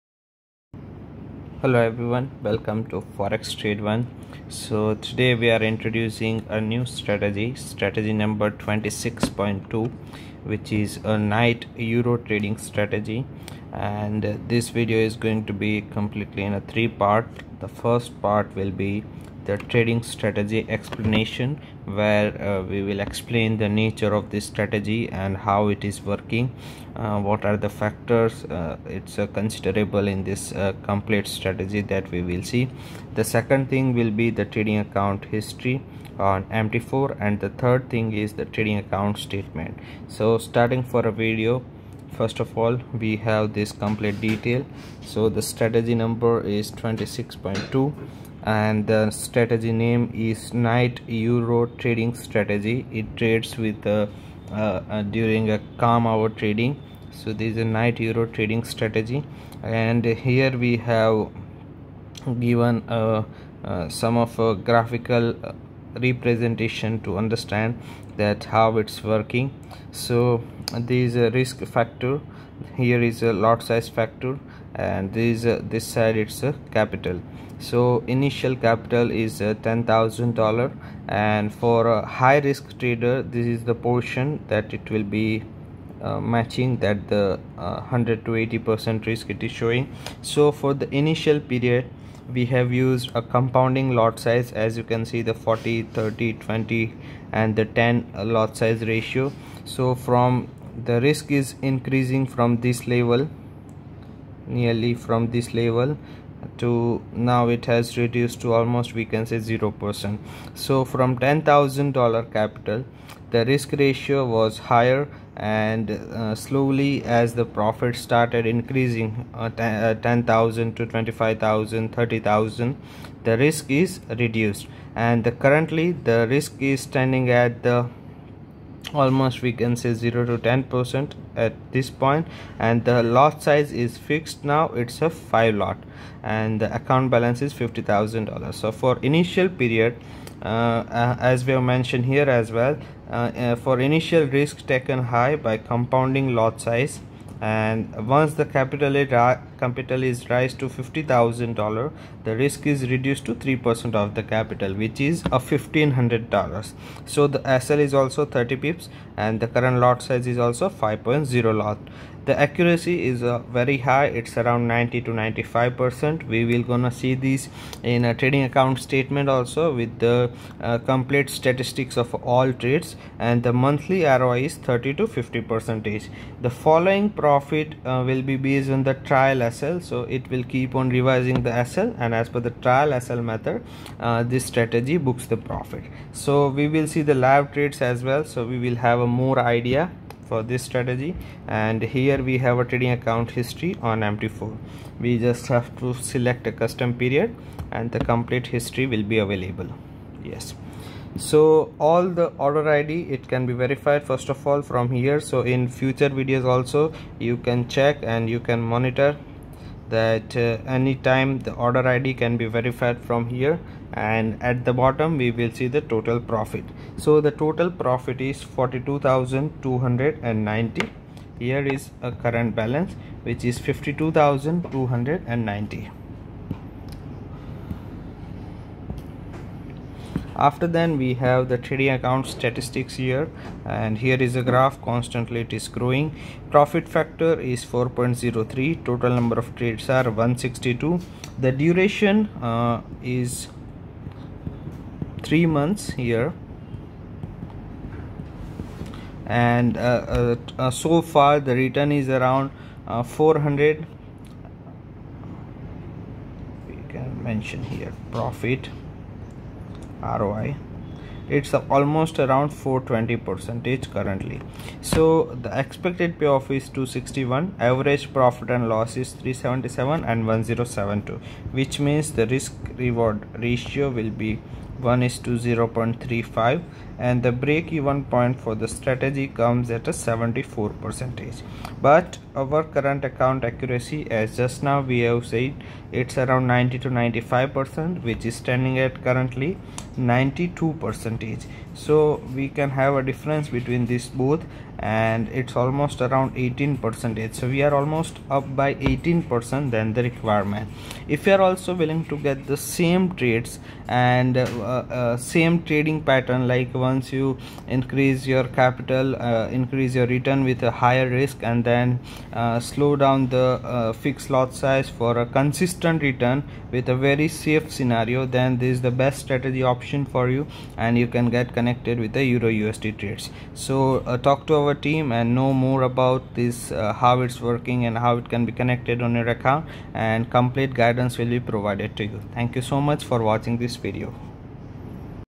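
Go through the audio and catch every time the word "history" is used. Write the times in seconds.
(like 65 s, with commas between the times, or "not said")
35 s, 193 s, 198 s.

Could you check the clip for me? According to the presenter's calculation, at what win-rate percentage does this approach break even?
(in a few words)
74%.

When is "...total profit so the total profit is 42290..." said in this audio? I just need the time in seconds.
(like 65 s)
215 s.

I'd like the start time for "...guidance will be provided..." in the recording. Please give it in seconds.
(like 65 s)
330 s.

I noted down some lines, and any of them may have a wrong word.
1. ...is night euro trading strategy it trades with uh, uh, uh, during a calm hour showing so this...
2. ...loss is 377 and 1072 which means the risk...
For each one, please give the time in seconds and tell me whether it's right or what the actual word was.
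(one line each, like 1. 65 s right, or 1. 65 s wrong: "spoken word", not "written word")
1. 50 s wrong: "trading", not "showing"
2. 268 s right.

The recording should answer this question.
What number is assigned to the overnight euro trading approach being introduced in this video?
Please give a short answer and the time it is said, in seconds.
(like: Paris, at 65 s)
26.2, at 7 s.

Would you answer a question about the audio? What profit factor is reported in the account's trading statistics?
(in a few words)
4.03.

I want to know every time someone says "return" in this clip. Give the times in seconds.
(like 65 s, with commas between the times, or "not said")
251 s, 310 s, 316 s.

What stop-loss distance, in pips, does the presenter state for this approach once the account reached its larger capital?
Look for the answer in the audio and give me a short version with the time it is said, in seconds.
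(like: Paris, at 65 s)
30 pips, at 158 s.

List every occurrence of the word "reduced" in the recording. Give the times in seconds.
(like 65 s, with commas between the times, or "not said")
107 s, 124 s, 152 s.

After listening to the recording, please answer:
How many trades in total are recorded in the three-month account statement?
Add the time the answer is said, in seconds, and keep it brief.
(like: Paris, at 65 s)
162, at 240 s.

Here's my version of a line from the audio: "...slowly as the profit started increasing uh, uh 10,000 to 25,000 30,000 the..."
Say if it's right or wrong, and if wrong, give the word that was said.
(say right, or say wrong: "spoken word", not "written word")
right.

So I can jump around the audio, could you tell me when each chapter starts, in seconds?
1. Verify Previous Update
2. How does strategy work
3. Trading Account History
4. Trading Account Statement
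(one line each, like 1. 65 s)
1. 10 s
2. 40 s
3. 195 s
4. 230 s.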